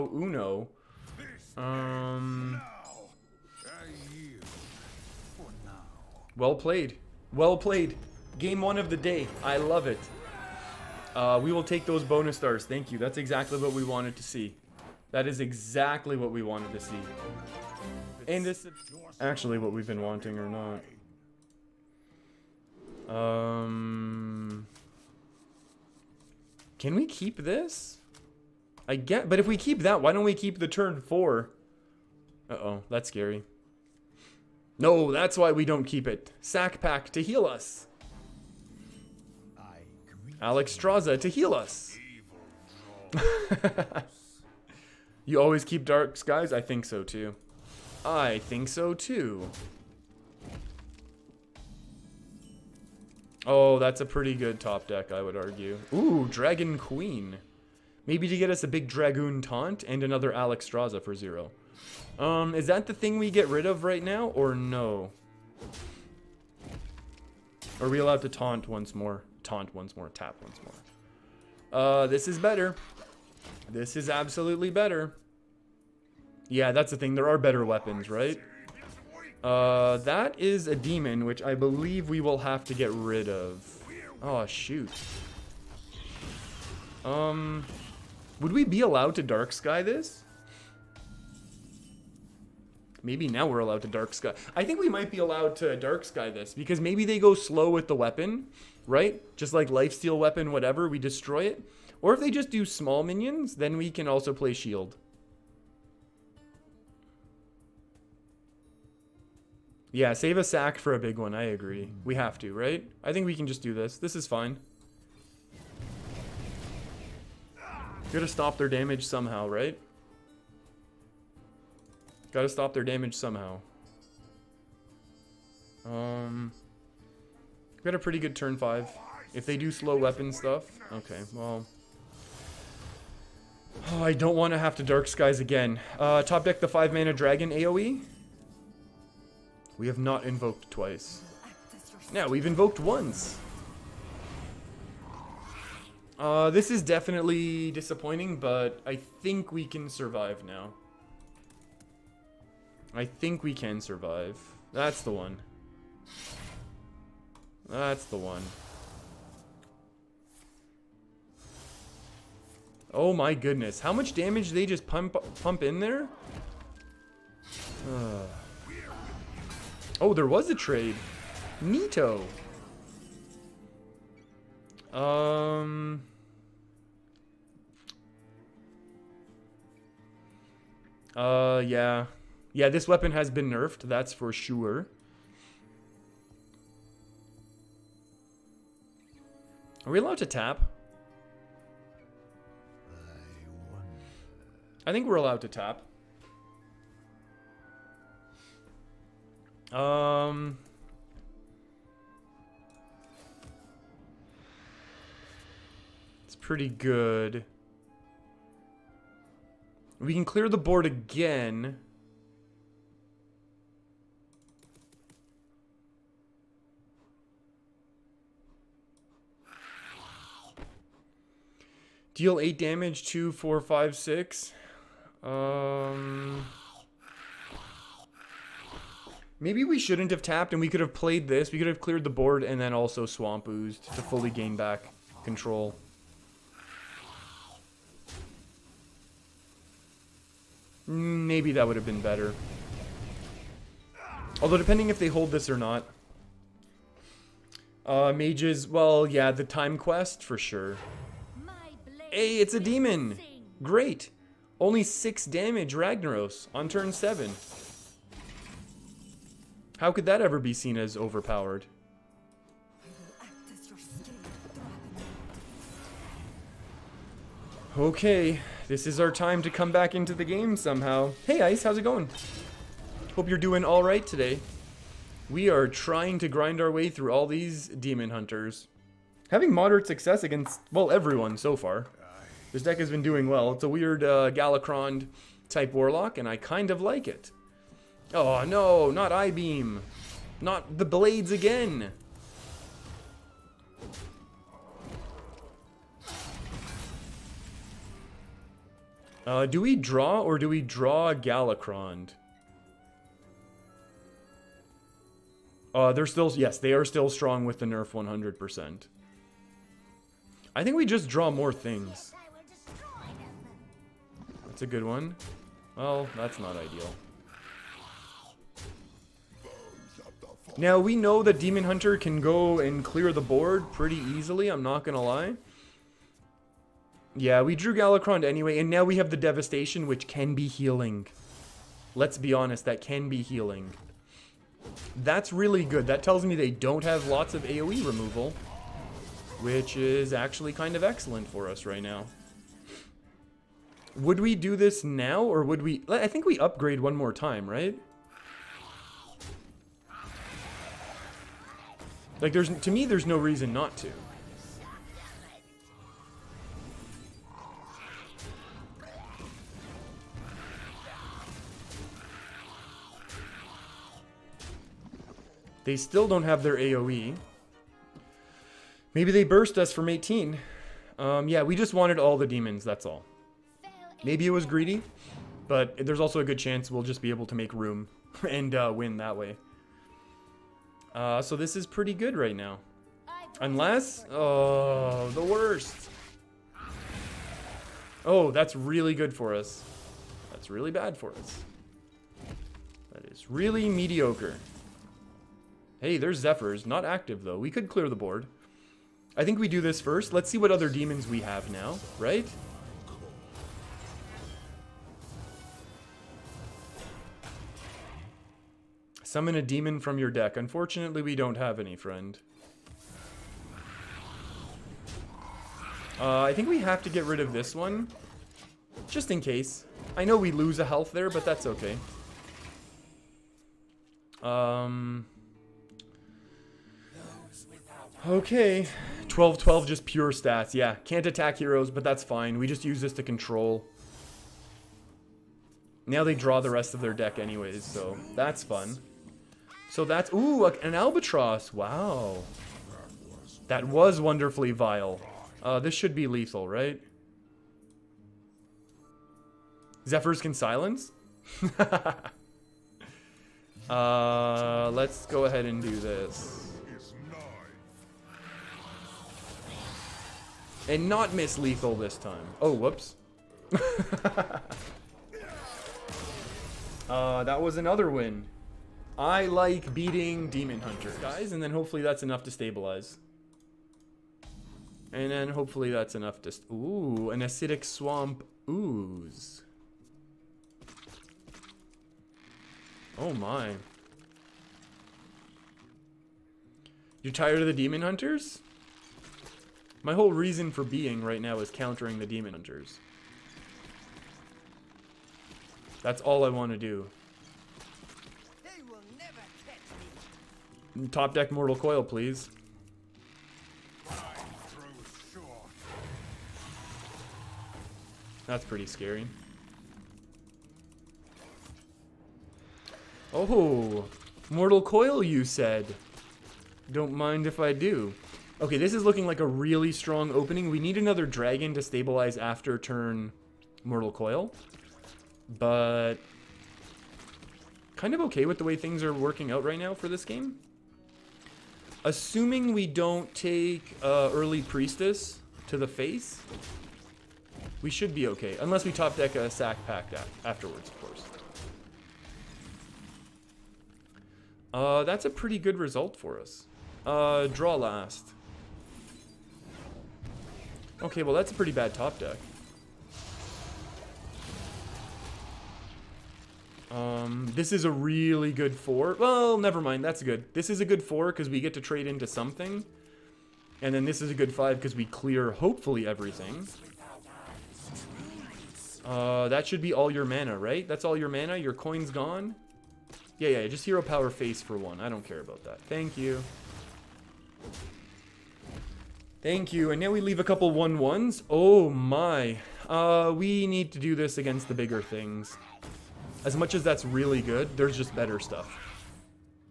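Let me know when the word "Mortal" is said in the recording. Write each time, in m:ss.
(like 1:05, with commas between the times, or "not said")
8:21, 8:34, 8:43.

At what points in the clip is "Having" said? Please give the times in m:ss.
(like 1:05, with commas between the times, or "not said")
4:39.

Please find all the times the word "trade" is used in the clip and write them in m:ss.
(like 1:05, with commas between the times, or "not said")
2:50, 9:21.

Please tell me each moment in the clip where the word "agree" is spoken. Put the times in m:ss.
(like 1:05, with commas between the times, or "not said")
1:51.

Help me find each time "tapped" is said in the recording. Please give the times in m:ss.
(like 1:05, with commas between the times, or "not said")
3:50.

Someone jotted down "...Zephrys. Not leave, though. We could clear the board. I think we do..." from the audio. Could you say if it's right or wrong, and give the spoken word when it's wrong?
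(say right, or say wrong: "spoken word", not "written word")
wrong: "active", not "leave".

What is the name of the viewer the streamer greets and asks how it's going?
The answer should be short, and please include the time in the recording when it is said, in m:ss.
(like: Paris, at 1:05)
Ice, at 4:31.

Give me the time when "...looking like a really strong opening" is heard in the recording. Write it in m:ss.
8:38.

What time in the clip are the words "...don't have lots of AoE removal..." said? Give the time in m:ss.
5:36.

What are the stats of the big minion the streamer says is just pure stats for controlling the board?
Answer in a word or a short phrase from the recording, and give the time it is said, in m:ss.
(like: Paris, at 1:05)
12/12, at 7:09.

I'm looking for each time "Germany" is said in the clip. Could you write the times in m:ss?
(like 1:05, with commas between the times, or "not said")
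not said.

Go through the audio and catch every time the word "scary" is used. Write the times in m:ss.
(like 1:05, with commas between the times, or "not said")
0:33, 8:28.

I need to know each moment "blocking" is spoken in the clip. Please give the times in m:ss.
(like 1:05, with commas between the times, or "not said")
not said.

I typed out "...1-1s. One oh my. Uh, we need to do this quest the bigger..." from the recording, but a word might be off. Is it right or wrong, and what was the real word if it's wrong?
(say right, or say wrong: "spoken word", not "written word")
wrong: "against", not "quest".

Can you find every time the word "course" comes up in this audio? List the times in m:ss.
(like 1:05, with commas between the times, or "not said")
9:00.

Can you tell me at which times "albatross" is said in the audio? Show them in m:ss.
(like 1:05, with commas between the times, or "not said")
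7:20.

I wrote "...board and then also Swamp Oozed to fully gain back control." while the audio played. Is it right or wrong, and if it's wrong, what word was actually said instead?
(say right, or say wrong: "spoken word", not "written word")
right.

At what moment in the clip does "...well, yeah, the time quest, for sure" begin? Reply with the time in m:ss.
4:08.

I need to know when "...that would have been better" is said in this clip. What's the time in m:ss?
4:01.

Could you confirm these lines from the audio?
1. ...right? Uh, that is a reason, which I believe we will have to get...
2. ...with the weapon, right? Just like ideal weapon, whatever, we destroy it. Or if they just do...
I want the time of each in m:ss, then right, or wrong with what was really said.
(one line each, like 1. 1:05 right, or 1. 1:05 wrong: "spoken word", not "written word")
1. 1:18 wrong: "demon", not "reason"
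2. 1:37 wrong: "lifesteal", not "ideal".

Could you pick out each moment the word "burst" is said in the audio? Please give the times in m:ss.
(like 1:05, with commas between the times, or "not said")
6:09.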